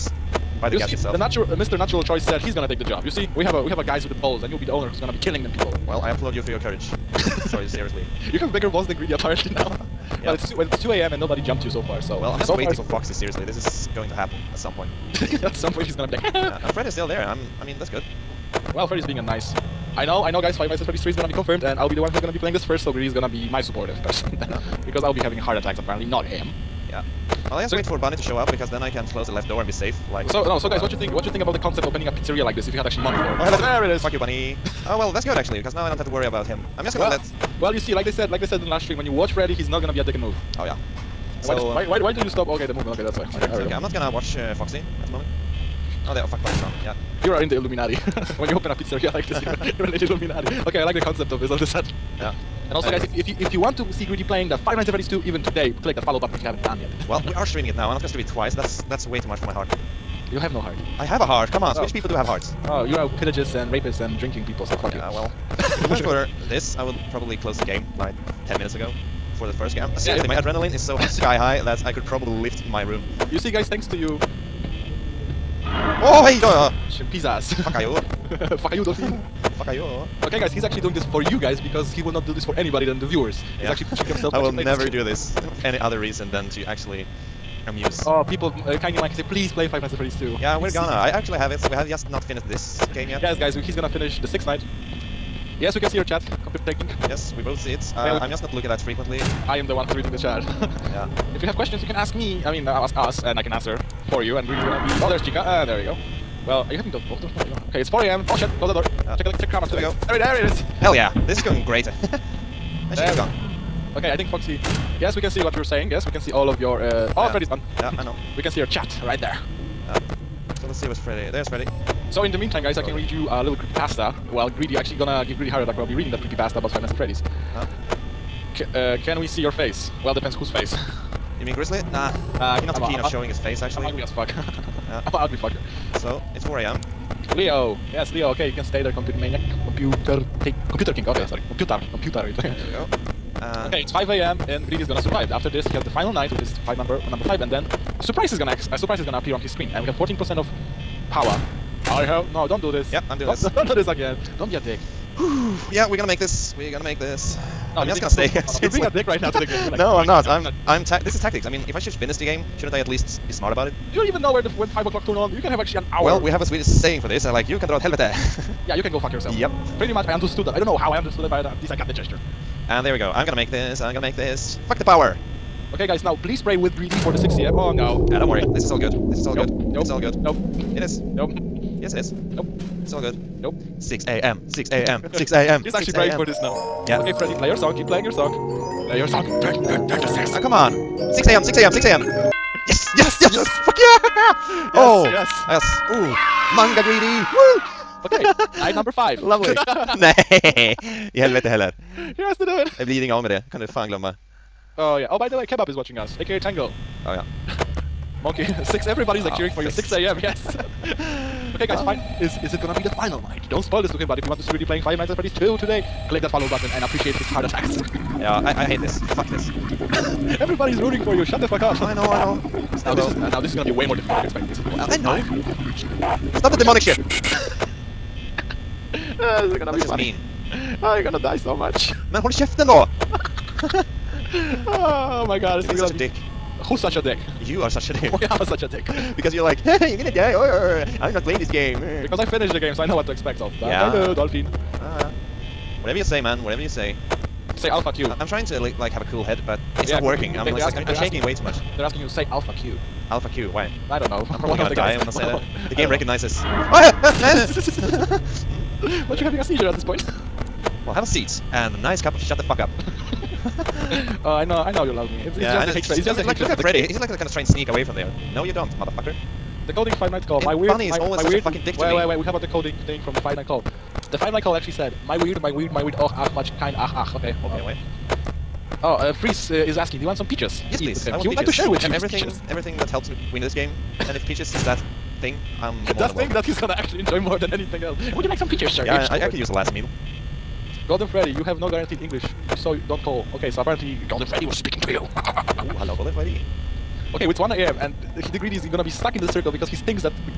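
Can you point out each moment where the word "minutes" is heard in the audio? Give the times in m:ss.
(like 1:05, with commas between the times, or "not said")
1:08.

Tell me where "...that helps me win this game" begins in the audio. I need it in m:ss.
4:42.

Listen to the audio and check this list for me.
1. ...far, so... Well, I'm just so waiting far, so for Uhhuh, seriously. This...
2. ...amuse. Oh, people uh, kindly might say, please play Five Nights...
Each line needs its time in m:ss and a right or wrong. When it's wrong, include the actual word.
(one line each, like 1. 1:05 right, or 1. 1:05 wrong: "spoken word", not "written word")
1. 0:11 wrong: "Foxy", not "Uhhuh"
2. 1:27 right.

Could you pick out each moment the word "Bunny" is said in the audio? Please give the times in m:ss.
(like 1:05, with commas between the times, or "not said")
0:27, 0:34, 4:30.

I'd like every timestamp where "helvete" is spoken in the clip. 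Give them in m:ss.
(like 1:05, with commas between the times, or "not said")
2:47, 3:21.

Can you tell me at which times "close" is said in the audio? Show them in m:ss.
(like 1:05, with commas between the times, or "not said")
0:29, 1:07, 1:48.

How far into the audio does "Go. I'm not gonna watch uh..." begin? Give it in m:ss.
0:43.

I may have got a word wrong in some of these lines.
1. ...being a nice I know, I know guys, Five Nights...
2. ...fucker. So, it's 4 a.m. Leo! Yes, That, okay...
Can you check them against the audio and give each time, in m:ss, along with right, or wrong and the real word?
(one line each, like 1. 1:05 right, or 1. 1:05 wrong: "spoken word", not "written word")
1. 0:19 right
2. 2:15 wrong: "Leo", not "That".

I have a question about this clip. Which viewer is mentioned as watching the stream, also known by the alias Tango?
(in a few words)
Kebab.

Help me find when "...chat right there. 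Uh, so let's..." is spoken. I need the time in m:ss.
1:58.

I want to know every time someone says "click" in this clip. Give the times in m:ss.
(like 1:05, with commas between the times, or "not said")
0:55, 3:36.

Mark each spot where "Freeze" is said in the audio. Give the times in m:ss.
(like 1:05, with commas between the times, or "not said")
4:39.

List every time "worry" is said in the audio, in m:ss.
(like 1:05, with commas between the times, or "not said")
0:36, 2:58.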